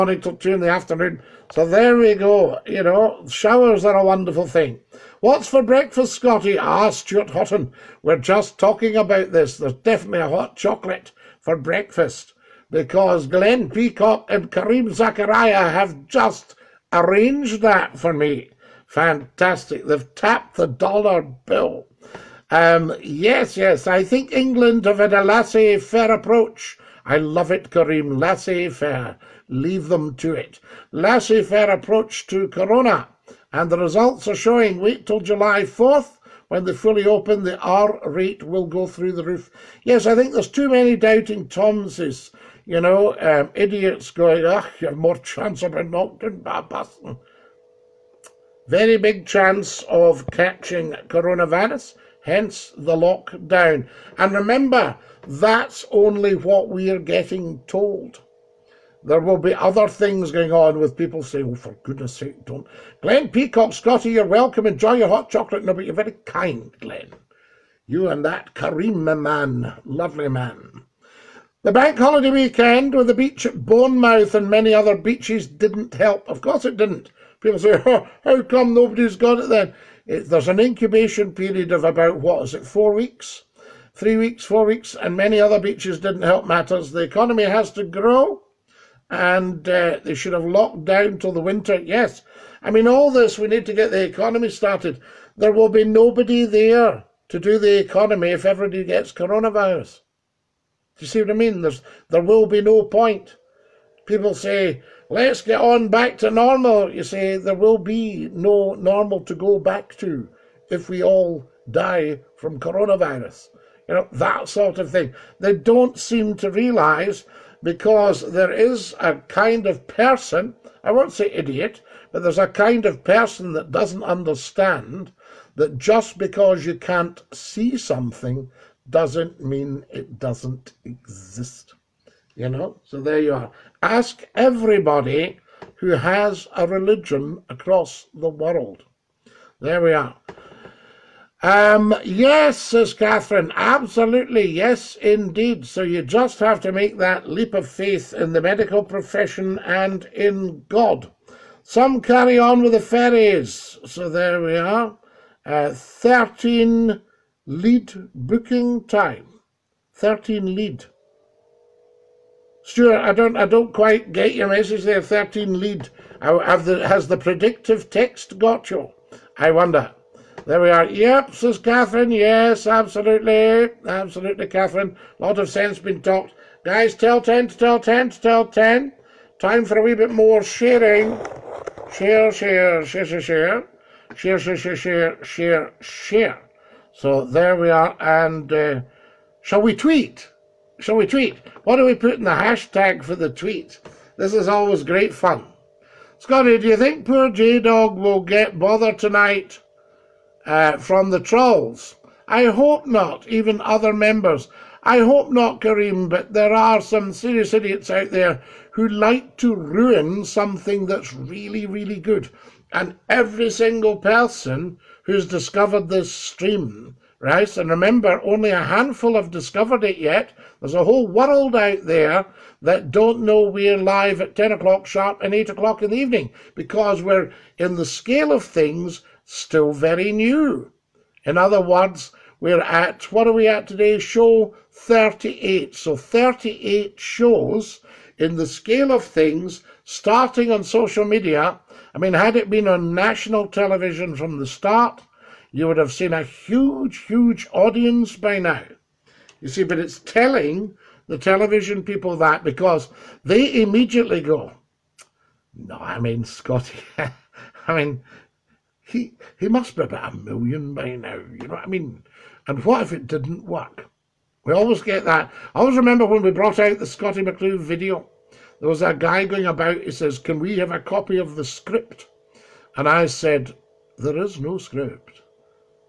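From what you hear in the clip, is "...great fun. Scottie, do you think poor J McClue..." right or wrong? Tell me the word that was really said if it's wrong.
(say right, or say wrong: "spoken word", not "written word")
wrong: "Dog", not "McClue".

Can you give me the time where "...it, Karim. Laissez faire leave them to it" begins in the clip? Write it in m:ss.
0:27.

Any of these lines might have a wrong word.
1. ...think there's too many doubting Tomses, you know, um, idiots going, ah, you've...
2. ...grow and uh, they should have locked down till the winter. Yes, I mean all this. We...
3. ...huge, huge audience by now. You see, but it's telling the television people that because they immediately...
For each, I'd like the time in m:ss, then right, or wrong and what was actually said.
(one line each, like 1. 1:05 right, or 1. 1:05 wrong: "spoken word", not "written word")
1. 0:40 right
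2. 1:27 right
3. 4:06 right.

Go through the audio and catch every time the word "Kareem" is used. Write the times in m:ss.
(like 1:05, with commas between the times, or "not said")
1:08, 3:25.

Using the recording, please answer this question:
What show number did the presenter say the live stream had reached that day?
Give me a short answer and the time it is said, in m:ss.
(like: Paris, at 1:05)
38, at 3:53.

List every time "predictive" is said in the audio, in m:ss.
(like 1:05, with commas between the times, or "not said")
2:47.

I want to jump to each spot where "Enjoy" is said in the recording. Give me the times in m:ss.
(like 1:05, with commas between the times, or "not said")
1:04.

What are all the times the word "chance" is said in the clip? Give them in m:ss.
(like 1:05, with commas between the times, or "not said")
0:45, 0:49.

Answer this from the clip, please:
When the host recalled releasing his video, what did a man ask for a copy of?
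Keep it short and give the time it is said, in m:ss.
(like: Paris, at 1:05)
the script, at 4:31.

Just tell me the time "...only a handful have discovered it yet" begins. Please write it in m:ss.
3:38.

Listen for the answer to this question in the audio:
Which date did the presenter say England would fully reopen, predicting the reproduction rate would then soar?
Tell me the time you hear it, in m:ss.
0:35.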